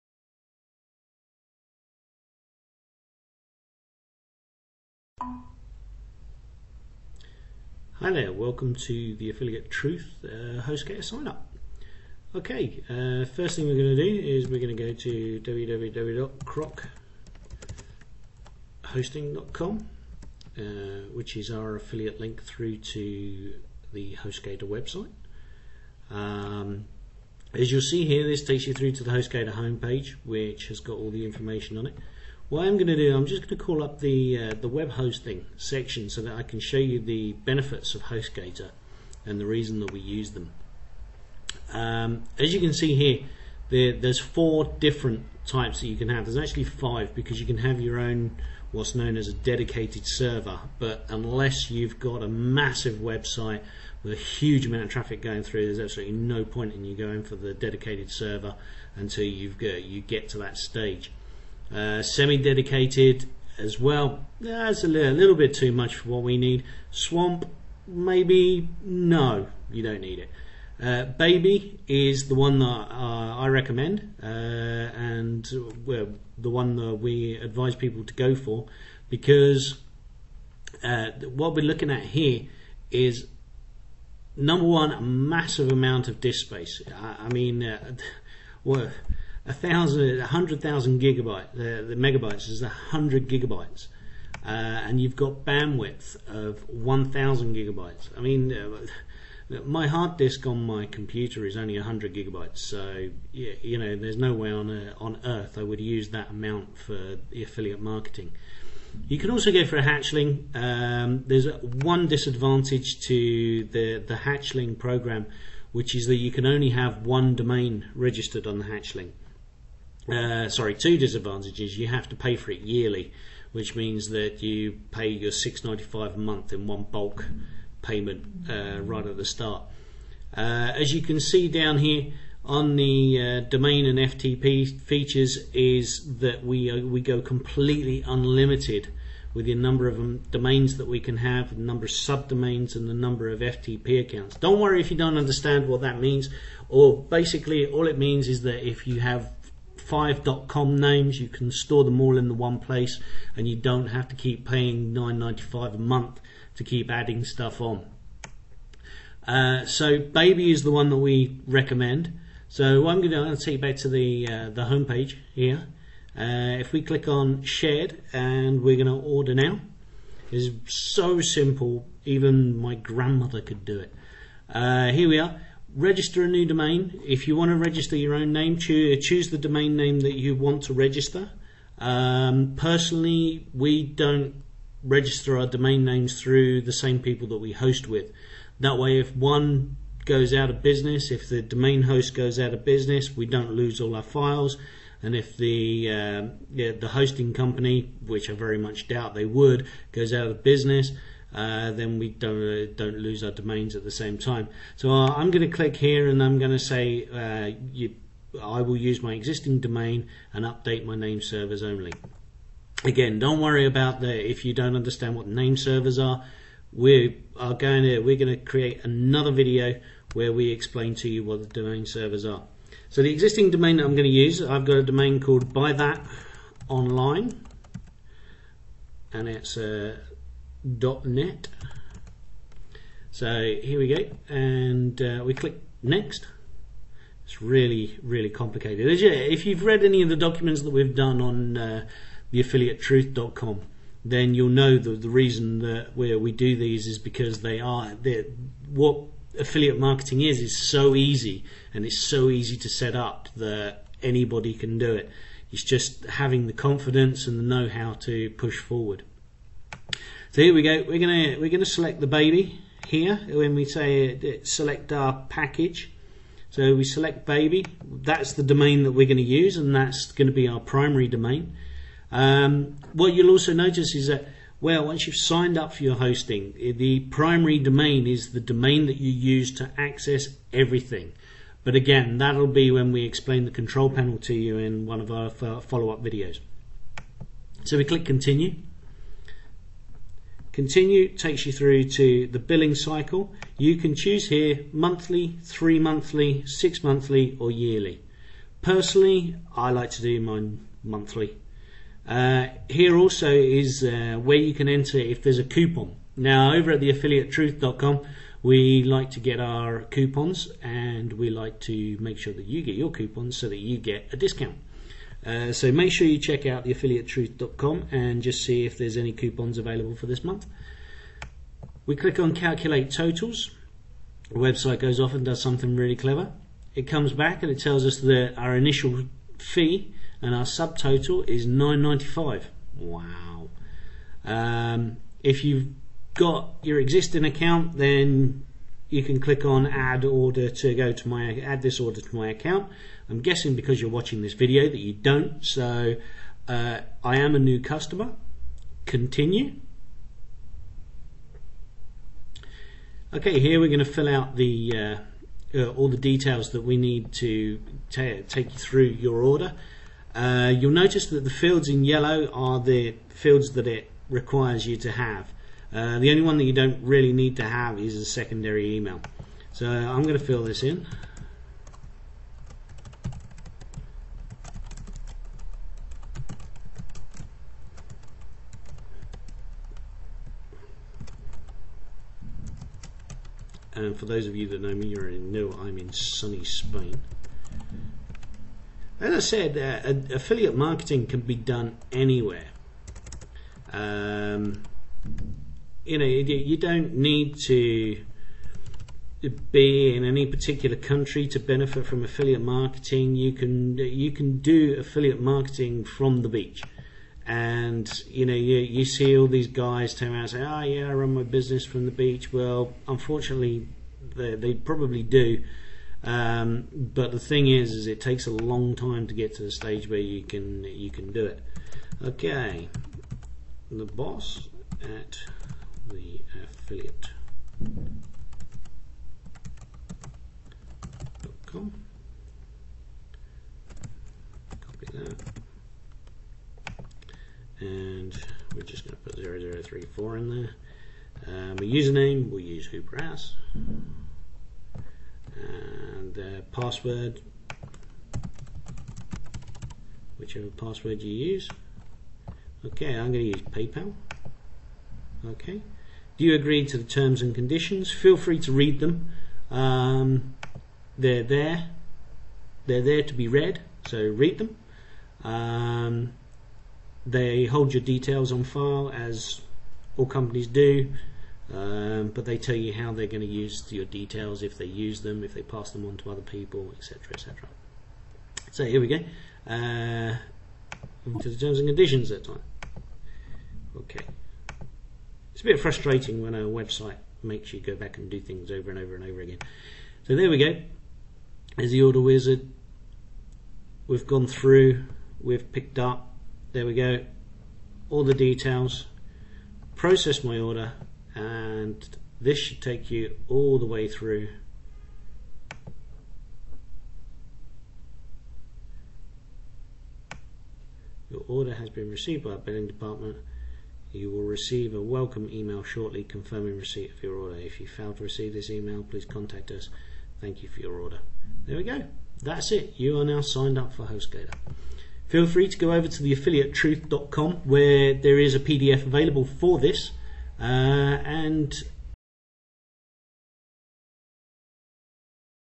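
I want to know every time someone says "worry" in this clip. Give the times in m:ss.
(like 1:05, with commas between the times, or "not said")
2:24, 3:33.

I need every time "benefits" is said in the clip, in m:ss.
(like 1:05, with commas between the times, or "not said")
0:37, 6:41.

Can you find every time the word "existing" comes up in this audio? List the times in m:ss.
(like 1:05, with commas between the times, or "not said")
3:29, 3:43, 5:36.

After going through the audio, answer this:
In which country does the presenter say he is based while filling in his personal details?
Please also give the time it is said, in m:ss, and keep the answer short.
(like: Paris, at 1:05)
Spain, at 6:25.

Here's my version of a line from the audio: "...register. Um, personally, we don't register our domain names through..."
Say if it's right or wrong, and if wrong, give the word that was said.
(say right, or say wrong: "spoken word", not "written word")
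right.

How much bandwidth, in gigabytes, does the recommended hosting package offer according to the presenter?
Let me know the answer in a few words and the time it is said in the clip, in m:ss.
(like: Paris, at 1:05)
1000 gigabytes, at 1:36.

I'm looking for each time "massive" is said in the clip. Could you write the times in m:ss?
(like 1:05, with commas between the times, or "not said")
0:52, 1:25.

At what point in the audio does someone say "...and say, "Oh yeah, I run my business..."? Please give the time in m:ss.
6:50.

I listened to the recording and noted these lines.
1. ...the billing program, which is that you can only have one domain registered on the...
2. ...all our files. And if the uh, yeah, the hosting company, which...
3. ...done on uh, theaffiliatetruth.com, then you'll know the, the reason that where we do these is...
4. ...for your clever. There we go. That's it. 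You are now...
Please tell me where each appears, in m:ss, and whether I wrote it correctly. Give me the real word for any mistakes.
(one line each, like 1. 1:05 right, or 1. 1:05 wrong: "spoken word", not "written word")
1. 1:53 wrong: "hatchling", not "billing"
2. 3:13 right
3. 4:00 right
4. 8:40 wrong: "order", not "clever".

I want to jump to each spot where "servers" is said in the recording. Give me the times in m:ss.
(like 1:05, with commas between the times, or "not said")
0:50, 0:58, 3:31, 3:35, 3:41.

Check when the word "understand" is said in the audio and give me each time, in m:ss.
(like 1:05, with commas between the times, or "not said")
2:25, 3:34.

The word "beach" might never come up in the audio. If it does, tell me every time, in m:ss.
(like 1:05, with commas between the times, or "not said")
6:46, 6:51.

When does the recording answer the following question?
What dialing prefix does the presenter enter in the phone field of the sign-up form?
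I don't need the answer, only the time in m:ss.
7:19.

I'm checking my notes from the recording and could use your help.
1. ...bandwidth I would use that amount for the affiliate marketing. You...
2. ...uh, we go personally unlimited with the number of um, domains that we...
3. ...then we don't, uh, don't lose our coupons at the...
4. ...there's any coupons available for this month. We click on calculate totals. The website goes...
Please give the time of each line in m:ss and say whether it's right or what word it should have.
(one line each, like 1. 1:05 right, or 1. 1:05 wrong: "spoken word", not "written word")
1. 1:45 wrong: "earth", not "bandwidth"
2. 2:16 wrong: "completely", not "personally"
3. 3:21 wrong: "domains", not "coupons"
4. 5:18 right.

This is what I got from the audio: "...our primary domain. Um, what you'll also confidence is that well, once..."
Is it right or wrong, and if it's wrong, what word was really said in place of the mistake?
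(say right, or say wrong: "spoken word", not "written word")
wrong: "notice", not "confidence".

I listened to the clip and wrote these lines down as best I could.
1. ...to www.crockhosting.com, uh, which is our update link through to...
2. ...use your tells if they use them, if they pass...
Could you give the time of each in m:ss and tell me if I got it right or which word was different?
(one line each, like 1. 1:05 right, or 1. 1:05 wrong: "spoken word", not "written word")
1. 0:14 wrong: "affiliate", not "update"
2. 7:53 wrong: "details", not "tells".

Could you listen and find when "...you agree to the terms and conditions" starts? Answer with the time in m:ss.
7:36.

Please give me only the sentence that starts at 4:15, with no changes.
It's just having the confidence and the know-how to push forward.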